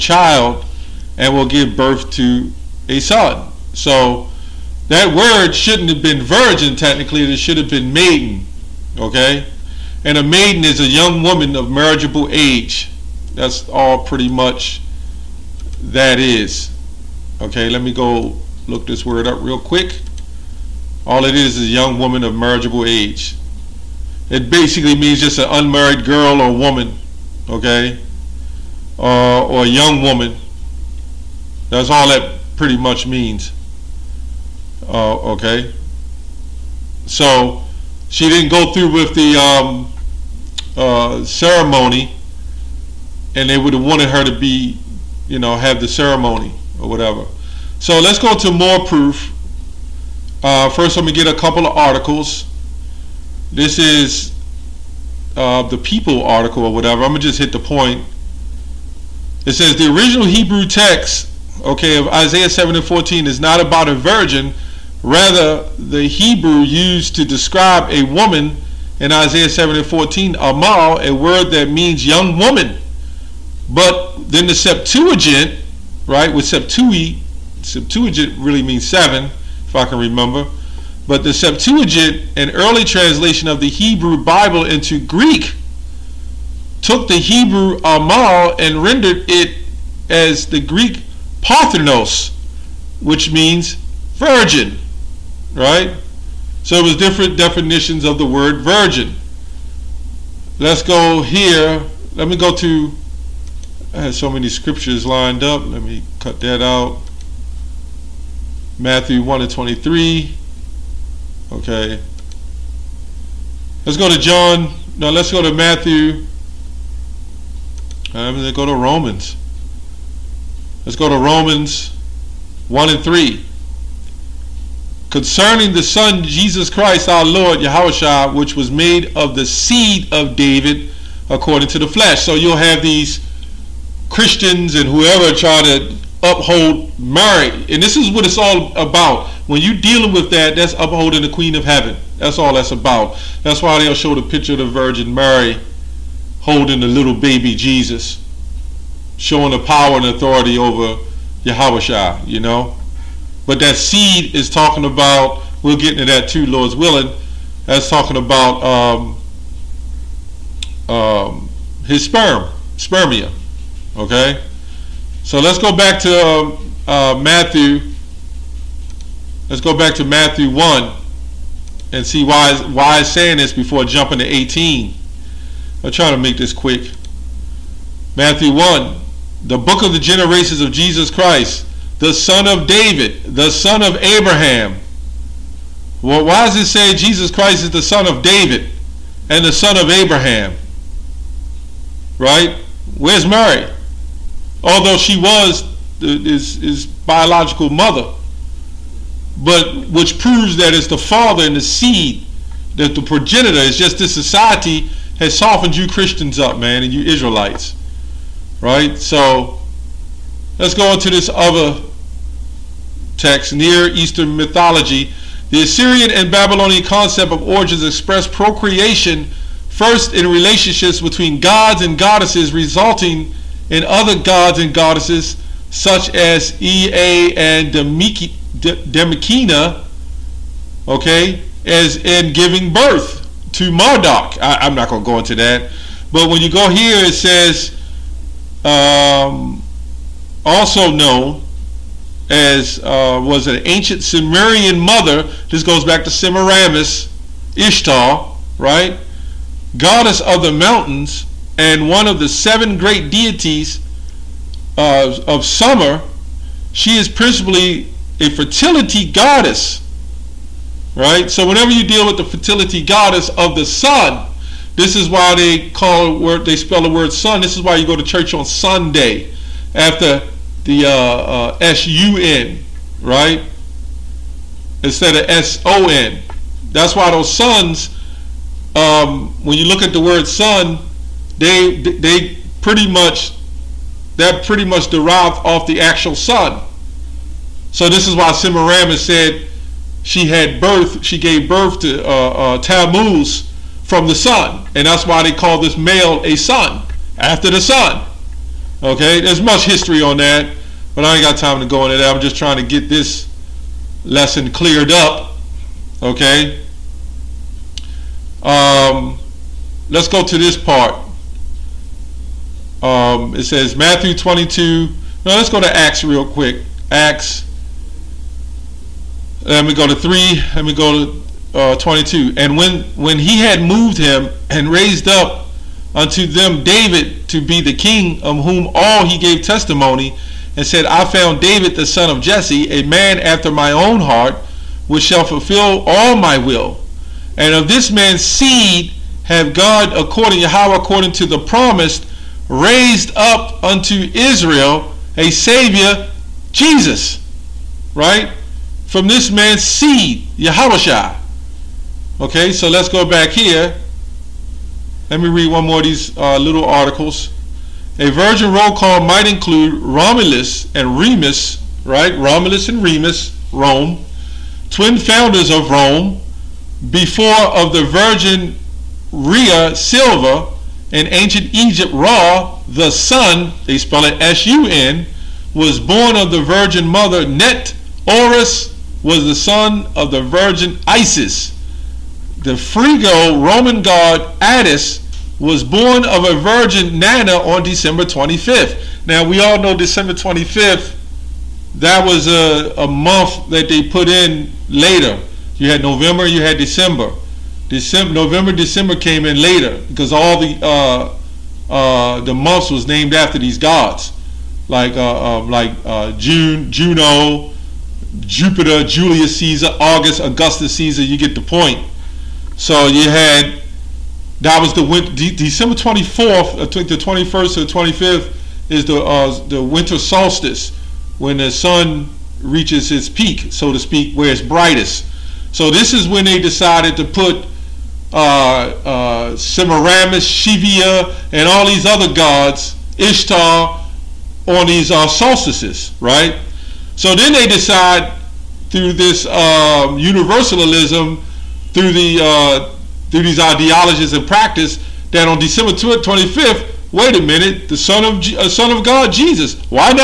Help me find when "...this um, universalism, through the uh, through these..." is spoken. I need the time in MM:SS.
07:18.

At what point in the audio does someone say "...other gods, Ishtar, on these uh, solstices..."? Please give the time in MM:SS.
07:11.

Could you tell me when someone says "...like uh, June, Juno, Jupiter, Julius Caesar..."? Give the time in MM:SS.
06:45.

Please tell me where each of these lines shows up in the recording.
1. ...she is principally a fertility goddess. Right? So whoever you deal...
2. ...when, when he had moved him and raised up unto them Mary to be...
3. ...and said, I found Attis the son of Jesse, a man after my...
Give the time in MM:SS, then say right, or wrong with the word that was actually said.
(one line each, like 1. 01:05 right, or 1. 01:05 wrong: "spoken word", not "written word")
1. 04:16 wrong: "whenever", not "whoever"
2. 05:22 wrong: "David", not "Mary"
3. 05:30 wrong: "David", not "Attis".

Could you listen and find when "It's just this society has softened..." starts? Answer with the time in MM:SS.
03:23.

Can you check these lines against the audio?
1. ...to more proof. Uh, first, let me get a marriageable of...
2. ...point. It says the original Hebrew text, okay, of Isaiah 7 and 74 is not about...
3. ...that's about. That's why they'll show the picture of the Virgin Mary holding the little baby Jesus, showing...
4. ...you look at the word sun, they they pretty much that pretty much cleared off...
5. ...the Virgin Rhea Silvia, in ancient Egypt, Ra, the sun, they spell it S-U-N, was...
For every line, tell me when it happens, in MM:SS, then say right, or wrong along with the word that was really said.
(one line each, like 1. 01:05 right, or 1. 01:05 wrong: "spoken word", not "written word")
1. 00:48 wrong: "couple", not "marriageable"
2. 00:57 wrong: "14", not "74"
3. 02:22 right
4. 04:39 wrong: "derived", not "cleared"
5. 06:07 right.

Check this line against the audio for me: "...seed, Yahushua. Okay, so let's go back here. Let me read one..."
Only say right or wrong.
right.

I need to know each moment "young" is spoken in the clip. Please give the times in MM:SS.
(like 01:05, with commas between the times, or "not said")
00:10, 00:21, 00:29, 01:12.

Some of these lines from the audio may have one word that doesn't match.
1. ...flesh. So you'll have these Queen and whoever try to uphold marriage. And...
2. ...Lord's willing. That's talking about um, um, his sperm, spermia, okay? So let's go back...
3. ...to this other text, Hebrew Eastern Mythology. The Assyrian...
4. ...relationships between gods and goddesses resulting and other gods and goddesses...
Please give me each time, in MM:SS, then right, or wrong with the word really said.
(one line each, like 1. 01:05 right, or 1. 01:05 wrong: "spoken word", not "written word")
1. 02:11 wrong: "Christians", not "Queen"
2. 02:36 right
3. 03:30 wrong: "Near", not "Hebrew"
4. 03:40 right.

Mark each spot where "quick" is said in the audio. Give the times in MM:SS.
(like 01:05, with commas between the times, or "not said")
00:19, 02:56, 05:16.